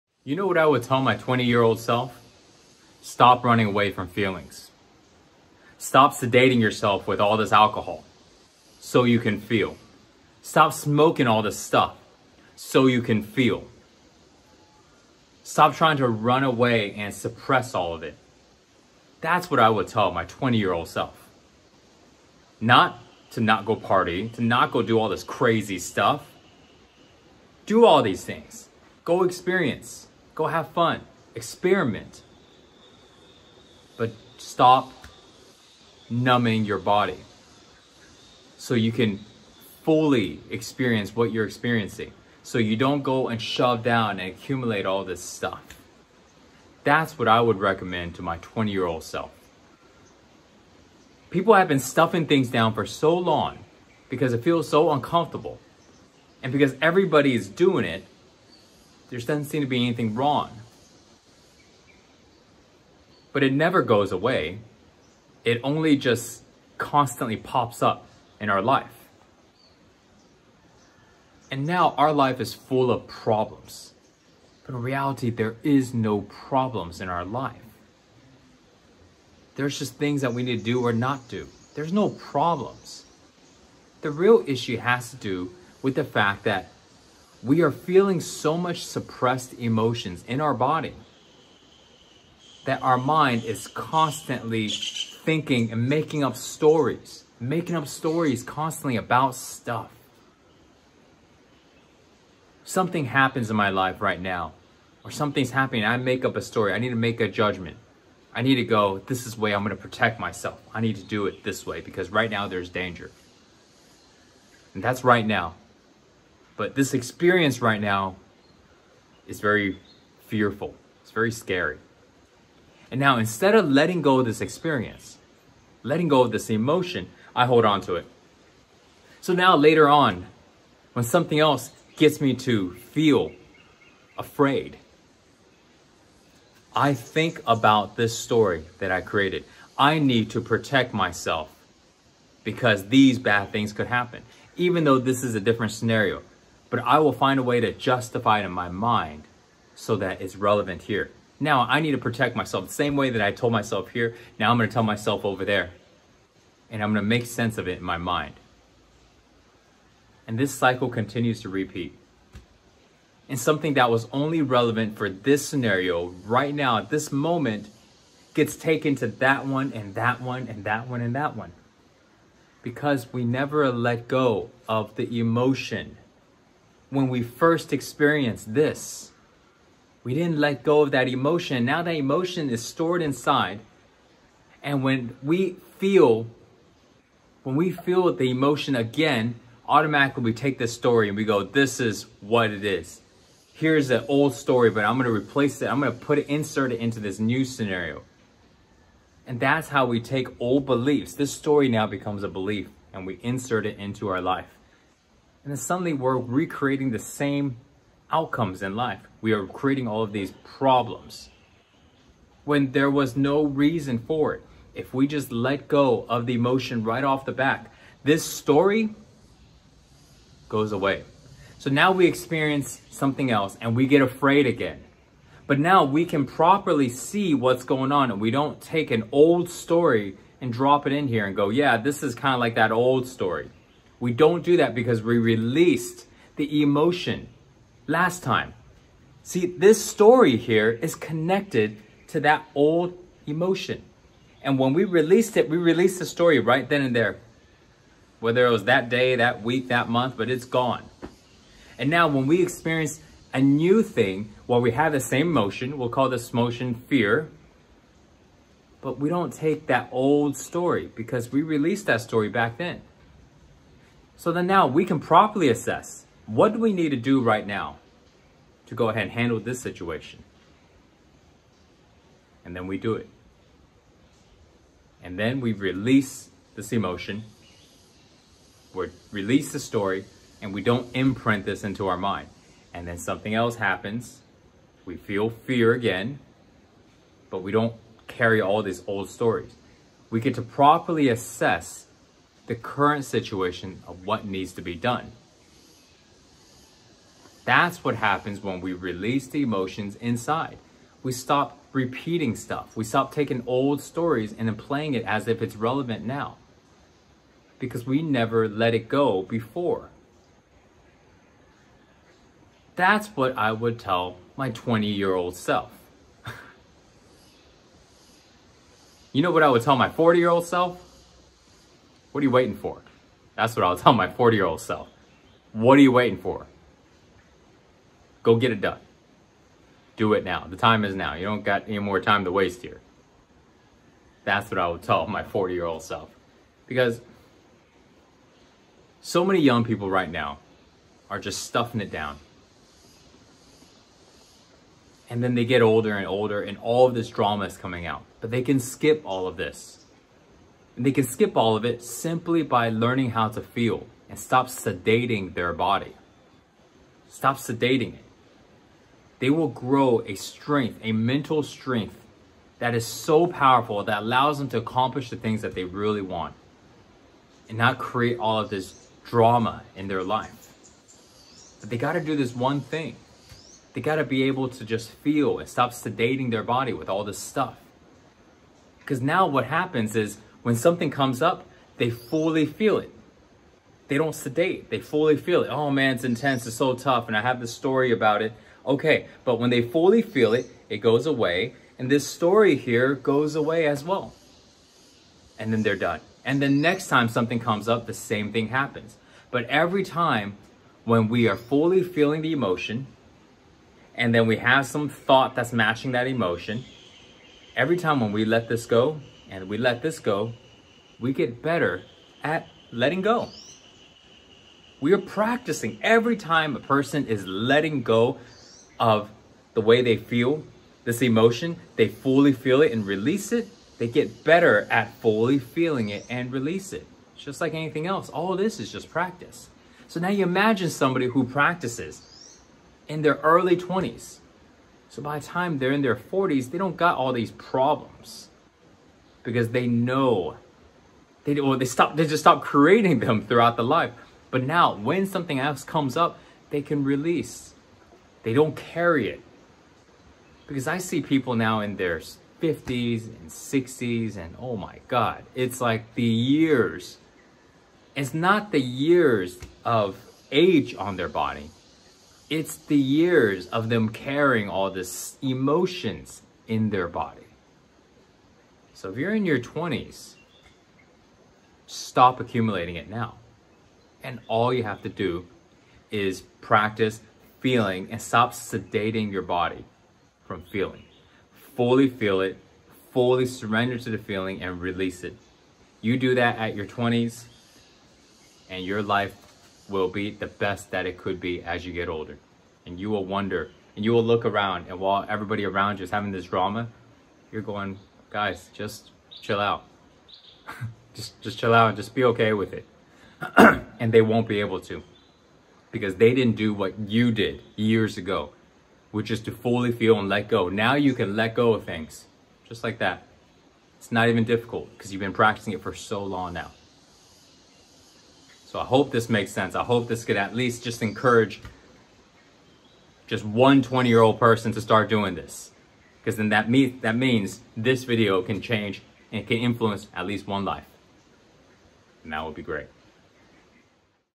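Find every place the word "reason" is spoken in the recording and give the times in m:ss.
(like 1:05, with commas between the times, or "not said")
3:33.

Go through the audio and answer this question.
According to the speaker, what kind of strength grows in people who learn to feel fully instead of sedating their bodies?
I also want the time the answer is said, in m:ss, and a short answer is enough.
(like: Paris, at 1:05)
mental strength, at 6:00.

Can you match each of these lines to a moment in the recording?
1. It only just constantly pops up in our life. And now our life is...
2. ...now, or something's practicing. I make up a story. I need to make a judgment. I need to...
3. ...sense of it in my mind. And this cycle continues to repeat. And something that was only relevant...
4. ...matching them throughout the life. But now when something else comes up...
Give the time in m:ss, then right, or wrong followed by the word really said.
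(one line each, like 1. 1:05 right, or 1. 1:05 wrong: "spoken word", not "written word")
1. 1:05 right
2. 1:44 wrong: "happening", not "practicing"
3. 2:37 right
4. 7:22 wrong: "creating", not "matching".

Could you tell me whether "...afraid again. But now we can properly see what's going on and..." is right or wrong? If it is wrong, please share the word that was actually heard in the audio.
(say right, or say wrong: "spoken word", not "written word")
right.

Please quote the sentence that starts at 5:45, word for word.
And then they get older and older, and all of this drama is coming out.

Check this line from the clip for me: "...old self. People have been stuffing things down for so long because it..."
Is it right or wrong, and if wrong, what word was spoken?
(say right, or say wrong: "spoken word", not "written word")
right.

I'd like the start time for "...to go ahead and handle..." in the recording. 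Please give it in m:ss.
4:28.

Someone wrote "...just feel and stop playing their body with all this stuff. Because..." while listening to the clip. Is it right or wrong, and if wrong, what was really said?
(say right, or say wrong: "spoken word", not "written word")
wrong: "sedating", not "playing".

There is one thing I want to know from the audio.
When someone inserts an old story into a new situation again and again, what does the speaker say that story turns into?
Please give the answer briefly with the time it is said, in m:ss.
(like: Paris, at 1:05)
a belief, at 3:22.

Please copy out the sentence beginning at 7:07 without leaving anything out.
It's just like anything else, all this is just practice.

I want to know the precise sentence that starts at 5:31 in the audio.
You don't got any more time to waste here.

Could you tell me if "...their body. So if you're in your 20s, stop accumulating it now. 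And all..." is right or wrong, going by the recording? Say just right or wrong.
right.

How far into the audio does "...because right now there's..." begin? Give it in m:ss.
1:51.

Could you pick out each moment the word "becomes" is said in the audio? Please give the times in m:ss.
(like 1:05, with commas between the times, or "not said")
3:21.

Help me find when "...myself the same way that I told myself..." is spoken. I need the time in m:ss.
2:32.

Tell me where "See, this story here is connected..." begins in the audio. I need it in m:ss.
3:59.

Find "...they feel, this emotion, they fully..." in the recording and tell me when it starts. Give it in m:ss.
6:59.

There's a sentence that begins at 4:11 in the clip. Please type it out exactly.
And now when we experience a new thing, well, we have the same emotion.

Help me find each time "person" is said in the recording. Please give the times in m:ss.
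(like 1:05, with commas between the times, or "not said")
6:56, 8:44.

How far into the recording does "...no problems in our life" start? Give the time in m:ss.
1:15.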